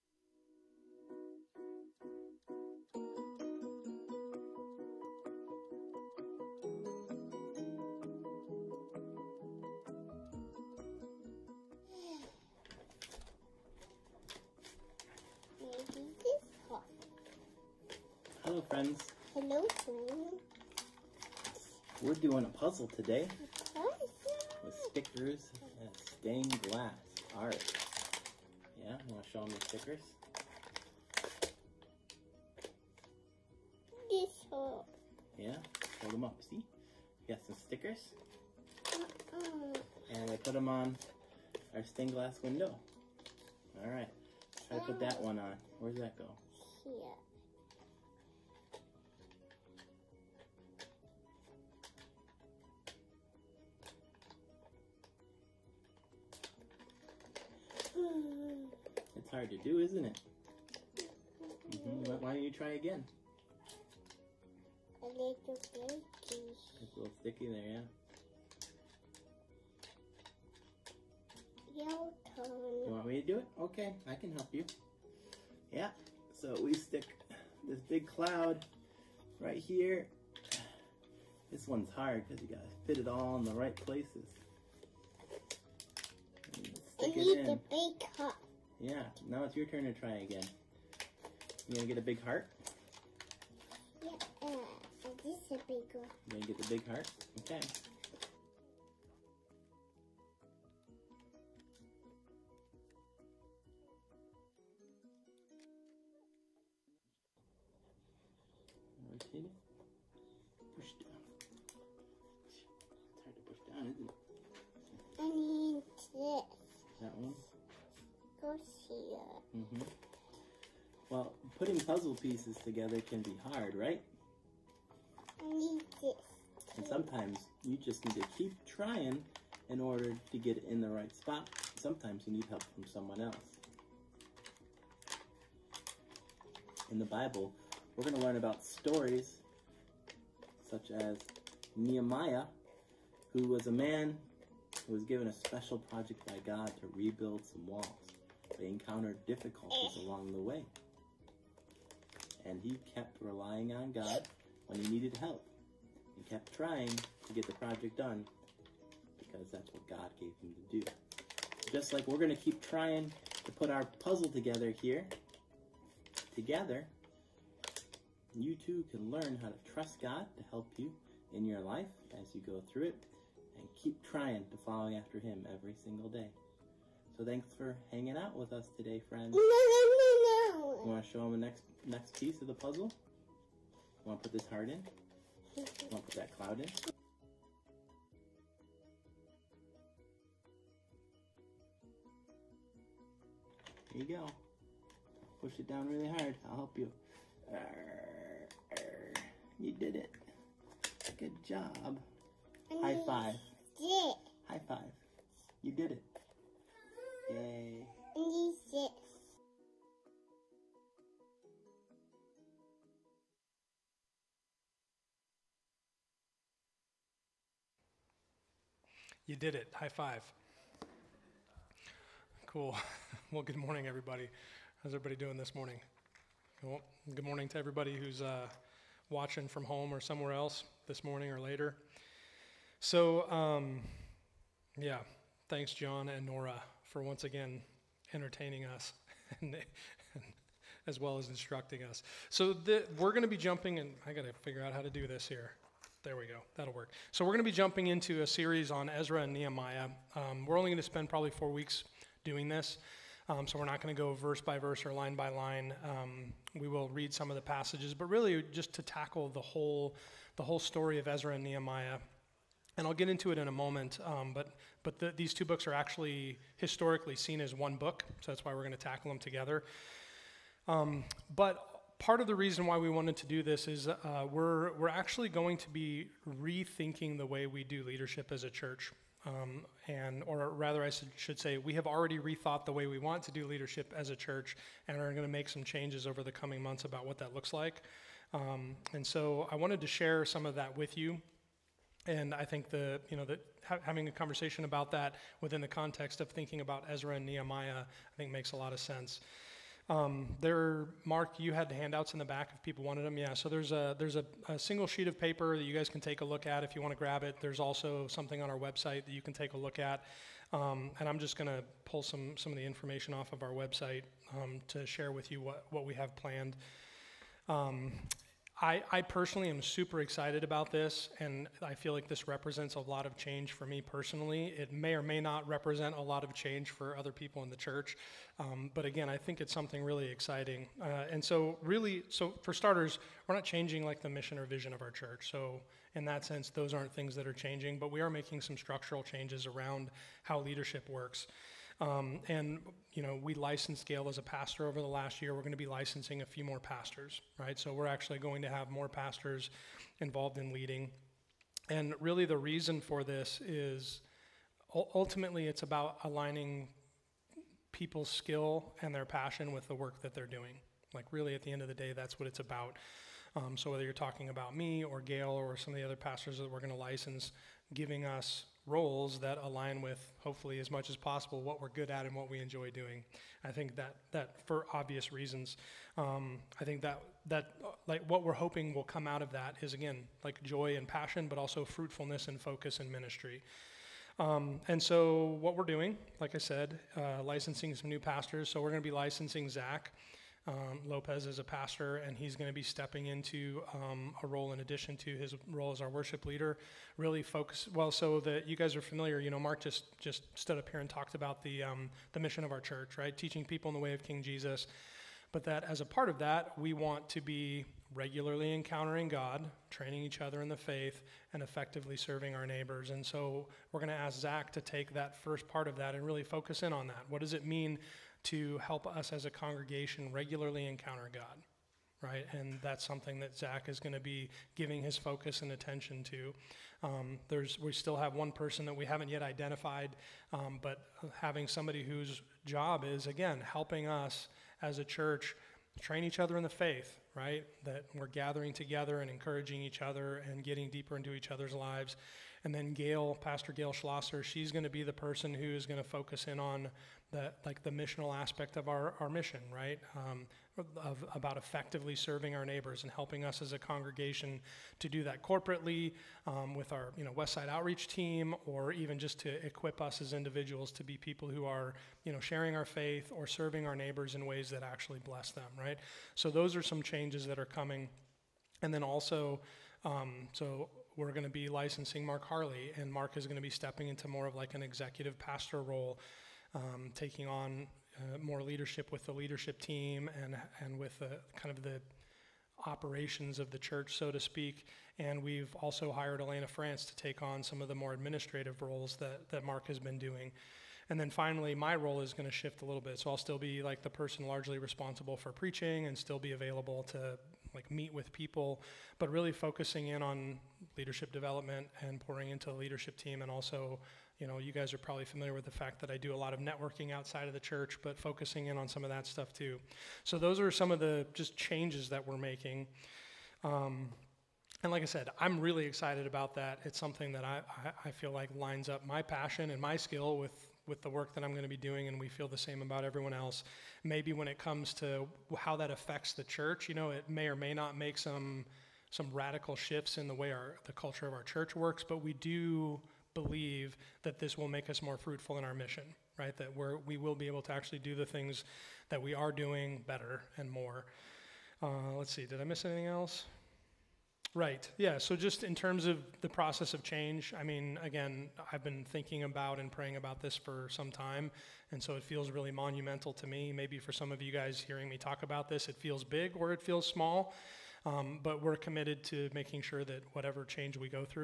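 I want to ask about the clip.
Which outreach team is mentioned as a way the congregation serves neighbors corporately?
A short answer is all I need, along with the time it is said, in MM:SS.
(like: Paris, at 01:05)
West Side outreach team, at 07:37.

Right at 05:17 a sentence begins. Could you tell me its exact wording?
Um, I, I personally am super excited about this, and I feel like this represents a lot of change for me personally.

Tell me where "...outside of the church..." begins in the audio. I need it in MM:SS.
08:26.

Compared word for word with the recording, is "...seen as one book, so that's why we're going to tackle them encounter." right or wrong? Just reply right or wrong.
wrong.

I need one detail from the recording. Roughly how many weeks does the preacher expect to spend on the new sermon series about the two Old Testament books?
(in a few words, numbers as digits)
4.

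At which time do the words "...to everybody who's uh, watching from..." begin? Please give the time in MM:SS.
03:47.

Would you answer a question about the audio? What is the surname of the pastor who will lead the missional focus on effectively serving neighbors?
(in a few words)
Schlosser.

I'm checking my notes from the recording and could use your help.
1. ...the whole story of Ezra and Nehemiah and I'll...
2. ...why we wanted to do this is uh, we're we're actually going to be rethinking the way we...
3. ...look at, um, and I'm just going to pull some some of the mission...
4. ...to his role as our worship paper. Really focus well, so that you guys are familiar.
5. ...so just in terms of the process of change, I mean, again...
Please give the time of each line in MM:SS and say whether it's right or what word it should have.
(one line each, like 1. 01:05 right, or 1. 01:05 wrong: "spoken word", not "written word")
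1. 04:20 right
2. 04:32 right
3. 05:09 wrong: "information", not "mission"
4. 06:34 wrong: "leader", not "paper"
5. 09:04 right.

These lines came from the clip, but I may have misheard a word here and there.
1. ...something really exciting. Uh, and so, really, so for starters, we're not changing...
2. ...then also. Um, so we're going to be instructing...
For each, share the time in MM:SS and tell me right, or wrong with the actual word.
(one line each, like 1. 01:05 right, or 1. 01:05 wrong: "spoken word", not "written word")
1. 05:29 right
2. 07:48 wrong: "licensing", not "instructing".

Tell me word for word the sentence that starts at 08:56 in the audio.
That we're, we will be able to actually do the things that we are doing better and more.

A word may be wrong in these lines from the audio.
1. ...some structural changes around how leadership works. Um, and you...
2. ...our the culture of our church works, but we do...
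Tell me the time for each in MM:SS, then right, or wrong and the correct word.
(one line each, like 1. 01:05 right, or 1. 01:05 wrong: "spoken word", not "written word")
1. 05:38 right
2. 08:50 right.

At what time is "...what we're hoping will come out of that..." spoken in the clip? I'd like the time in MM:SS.
06:18.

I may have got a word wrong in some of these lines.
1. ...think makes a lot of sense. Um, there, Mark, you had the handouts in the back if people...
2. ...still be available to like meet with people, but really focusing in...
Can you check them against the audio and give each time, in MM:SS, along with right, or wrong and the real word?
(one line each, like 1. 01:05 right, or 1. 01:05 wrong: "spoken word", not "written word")
1. 04:58 right
2. 08:15 right.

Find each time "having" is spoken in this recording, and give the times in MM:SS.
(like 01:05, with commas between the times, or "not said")
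04:53, 07:11.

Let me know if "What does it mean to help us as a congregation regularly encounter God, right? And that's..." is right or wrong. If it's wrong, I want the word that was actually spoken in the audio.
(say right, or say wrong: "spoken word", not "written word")
right.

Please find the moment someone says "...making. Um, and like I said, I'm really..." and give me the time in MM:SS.
08:32.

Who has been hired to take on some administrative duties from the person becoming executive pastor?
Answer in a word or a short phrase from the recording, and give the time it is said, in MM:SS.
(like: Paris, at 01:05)
Elena France, at 08:06.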